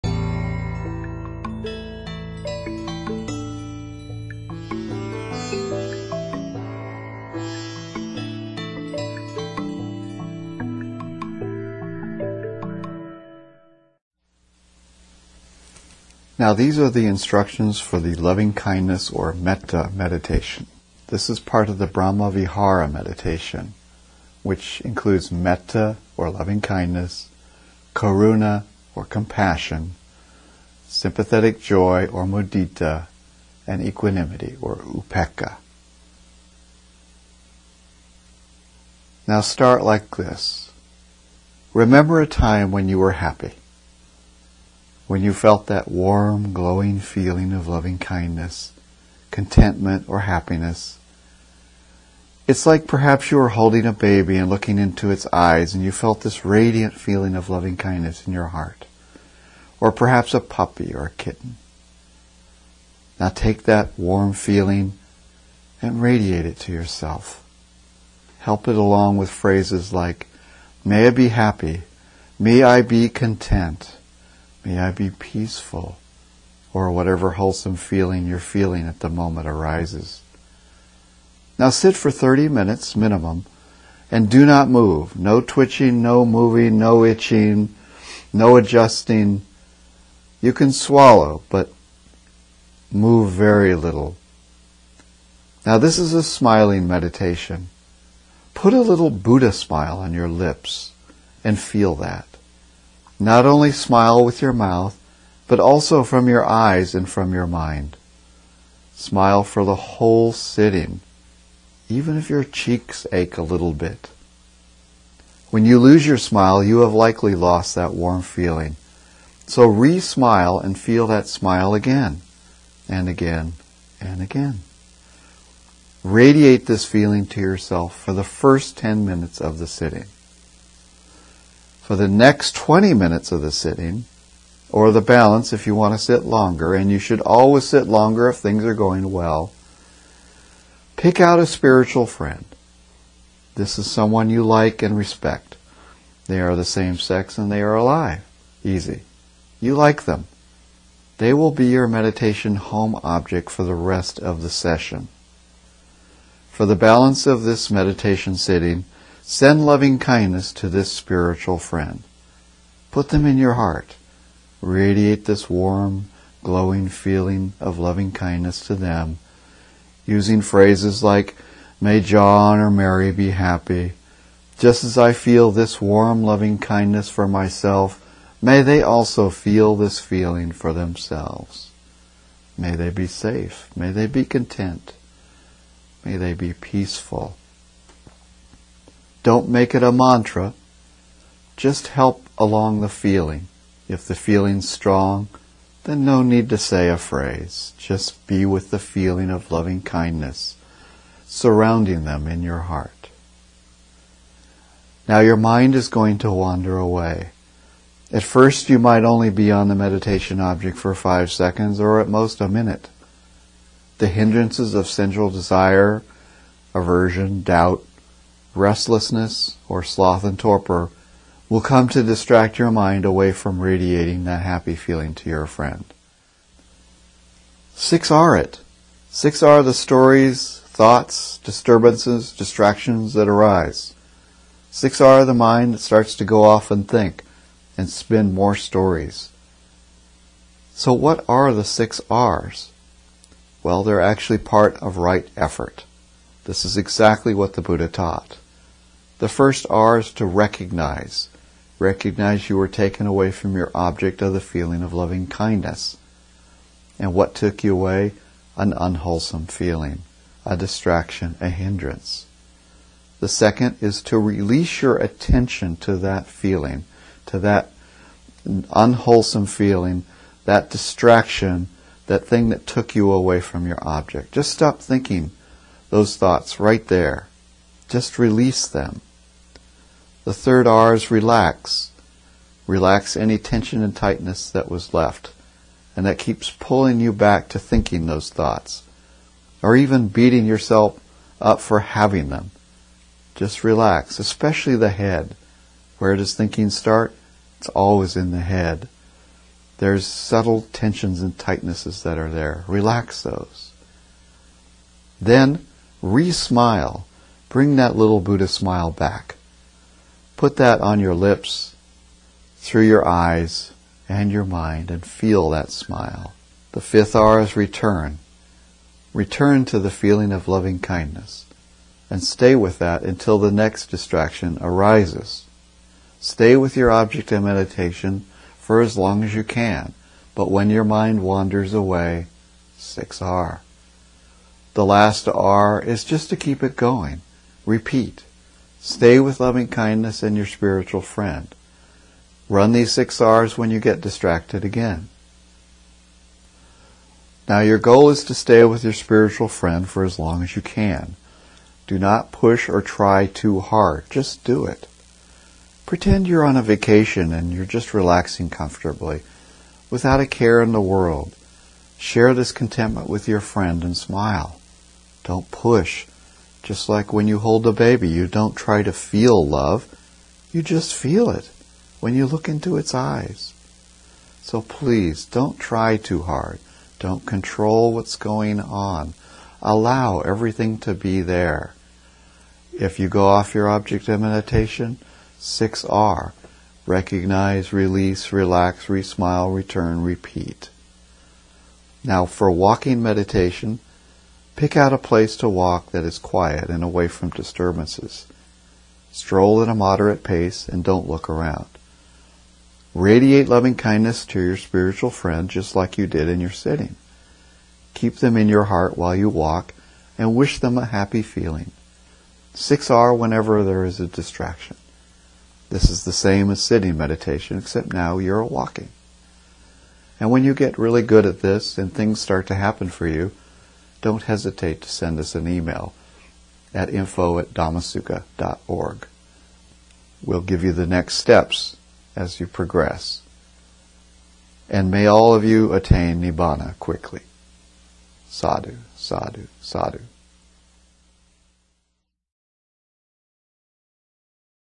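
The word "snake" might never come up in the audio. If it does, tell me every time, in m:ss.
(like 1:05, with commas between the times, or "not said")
not said.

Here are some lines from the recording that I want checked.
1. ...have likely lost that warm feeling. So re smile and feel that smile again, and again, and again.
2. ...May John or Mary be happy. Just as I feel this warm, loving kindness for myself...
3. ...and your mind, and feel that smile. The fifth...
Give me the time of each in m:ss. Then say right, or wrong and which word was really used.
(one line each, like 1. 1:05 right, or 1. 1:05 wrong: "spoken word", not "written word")
1. 1:56 right
2. 2:51 right
3. 5:14 right.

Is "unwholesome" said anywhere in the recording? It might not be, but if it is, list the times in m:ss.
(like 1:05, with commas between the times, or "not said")
4:18, 4:28.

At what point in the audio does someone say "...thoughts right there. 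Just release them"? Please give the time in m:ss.
4:36.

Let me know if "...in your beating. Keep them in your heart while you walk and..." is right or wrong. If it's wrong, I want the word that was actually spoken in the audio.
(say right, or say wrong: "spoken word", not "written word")
wrong: "sitting", not "beating".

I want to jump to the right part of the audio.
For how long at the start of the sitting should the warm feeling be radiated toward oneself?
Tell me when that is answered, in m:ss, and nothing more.
2:08.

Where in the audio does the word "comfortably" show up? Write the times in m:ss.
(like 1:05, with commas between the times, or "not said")
5:58.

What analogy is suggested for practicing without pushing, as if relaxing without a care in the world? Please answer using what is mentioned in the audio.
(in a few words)
a vacation.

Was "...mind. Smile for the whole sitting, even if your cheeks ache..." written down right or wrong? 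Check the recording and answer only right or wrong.
right.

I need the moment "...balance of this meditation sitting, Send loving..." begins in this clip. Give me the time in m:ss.
2:36.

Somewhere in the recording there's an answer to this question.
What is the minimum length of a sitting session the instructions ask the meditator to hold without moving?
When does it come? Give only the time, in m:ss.
1:22.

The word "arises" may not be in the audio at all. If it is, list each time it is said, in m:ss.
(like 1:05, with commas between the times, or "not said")
1:19, 3:53, 5:24.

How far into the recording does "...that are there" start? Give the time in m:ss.
5:02.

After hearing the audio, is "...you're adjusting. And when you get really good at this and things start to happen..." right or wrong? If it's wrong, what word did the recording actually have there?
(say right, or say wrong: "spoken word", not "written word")
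wrong: "walking", not "adjusting".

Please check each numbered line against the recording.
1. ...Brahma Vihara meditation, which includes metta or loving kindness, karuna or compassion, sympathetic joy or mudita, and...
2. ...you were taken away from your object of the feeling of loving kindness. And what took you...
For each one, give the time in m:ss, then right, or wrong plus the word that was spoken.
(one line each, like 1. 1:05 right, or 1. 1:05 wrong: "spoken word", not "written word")
1. 0:21 right
2. 4:12 right.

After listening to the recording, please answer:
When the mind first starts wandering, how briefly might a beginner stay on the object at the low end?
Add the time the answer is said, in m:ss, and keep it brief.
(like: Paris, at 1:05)
5 seconds, at 3:30.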